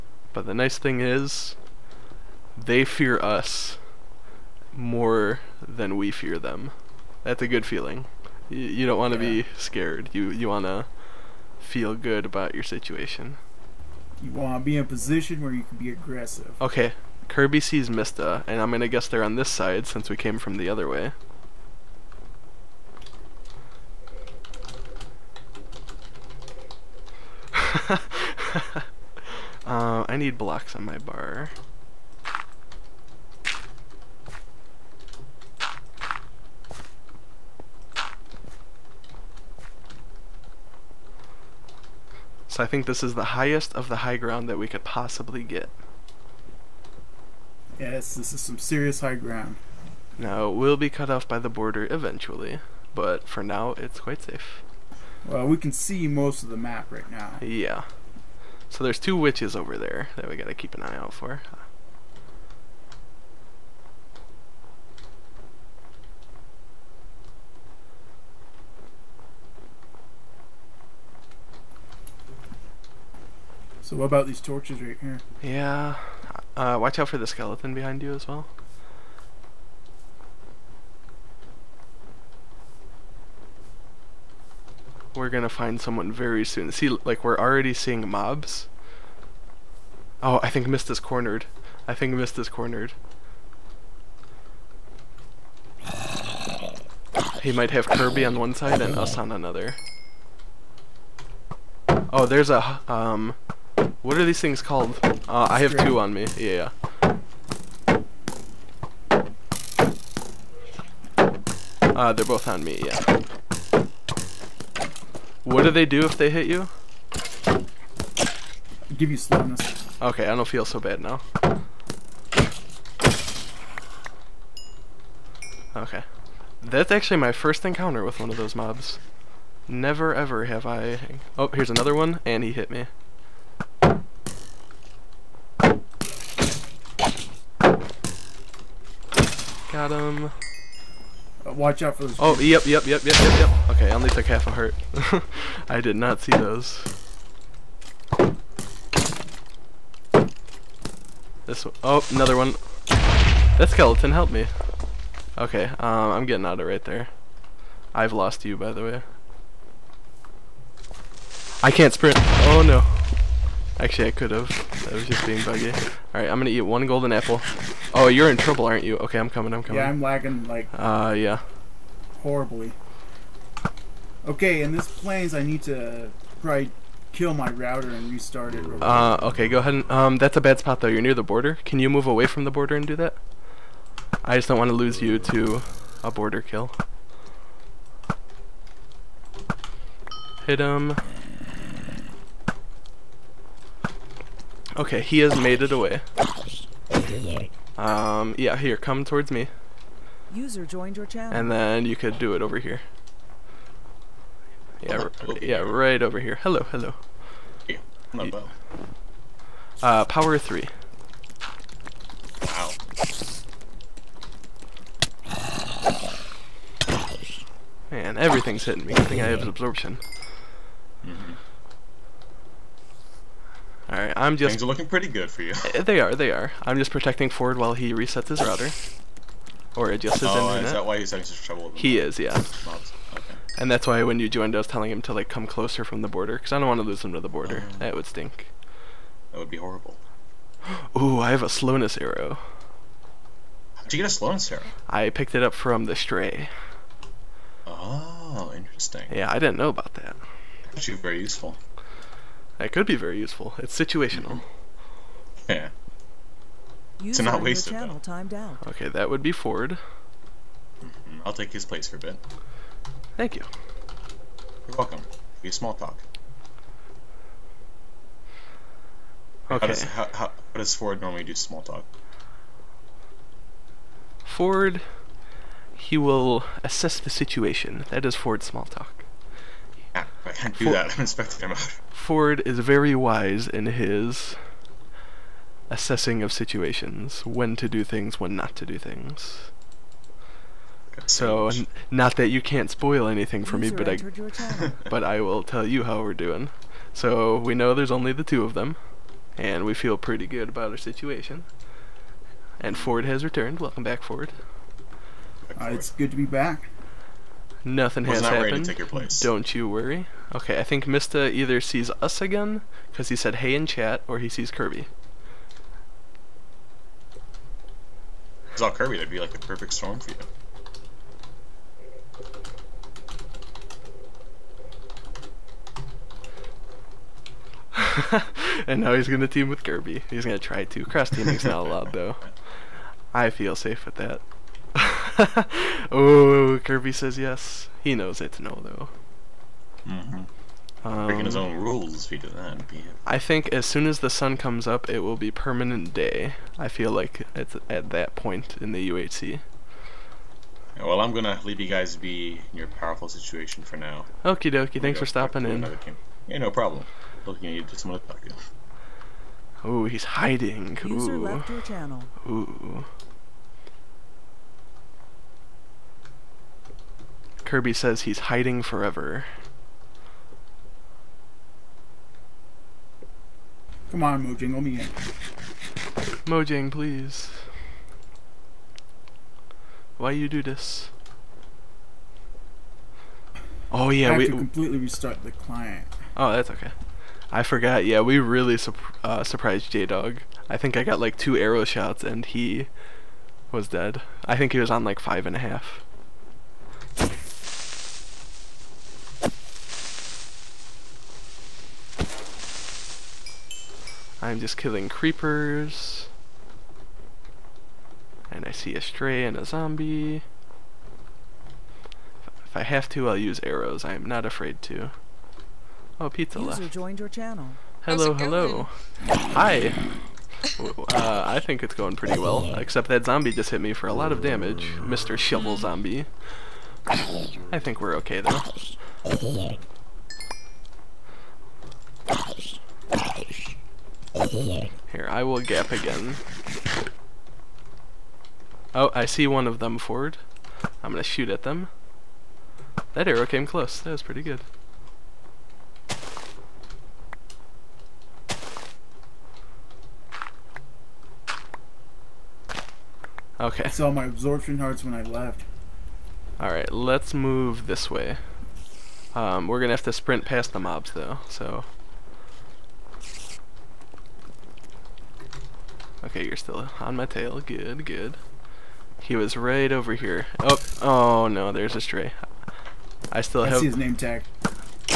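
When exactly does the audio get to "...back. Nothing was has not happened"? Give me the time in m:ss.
5:06.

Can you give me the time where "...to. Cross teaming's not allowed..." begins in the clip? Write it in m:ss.
5:30.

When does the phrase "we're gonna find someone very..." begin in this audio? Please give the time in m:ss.
1:25.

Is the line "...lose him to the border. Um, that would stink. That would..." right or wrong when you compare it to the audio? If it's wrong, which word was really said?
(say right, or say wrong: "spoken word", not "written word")
right.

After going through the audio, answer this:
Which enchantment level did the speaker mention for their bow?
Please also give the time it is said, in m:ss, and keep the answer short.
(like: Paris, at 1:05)
Power 3, at 3:30.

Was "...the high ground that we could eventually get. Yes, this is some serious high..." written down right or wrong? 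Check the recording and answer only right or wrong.
wrong.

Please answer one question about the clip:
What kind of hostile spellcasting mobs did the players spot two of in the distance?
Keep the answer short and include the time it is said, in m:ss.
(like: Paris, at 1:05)
witches, at 0:59.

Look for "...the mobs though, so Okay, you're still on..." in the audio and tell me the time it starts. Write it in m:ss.
7:40.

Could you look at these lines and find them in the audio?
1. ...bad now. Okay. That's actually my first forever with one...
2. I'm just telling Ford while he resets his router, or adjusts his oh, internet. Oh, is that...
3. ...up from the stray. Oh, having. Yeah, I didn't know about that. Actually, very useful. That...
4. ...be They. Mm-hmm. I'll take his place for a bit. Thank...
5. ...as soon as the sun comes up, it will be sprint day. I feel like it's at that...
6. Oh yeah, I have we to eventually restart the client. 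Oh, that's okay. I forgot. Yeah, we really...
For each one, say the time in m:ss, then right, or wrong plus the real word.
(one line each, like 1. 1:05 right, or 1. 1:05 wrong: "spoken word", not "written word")
1. 2:00 wrong: "encounter", not "forever"
2. 3:46 wrong: "protecting", not "telling"
3. 4:05 wrong: "interesting", not "having"
4. 4:19 wrong: "Ford", not "They"
5. 5:43 wrong: "permanent", not "sprint"
6. 6:23 wrong: "completely", not "eventually".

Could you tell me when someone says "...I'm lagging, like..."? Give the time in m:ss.
2:49.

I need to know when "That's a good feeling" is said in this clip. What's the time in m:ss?
0:07.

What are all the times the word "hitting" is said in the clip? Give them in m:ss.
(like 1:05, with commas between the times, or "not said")
3:38.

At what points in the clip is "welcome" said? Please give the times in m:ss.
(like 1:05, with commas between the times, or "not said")
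4:24, 5:03.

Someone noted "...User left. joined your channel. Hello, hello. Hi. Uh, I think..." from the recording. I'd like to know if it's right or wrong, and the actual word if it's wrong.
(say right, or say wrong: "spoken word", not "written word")
right.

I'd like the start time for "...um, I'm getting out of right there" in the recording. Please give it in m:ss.
2:35.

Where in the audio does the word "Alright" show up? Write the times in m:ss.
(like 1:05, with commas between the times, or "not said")
2:46, 7:36.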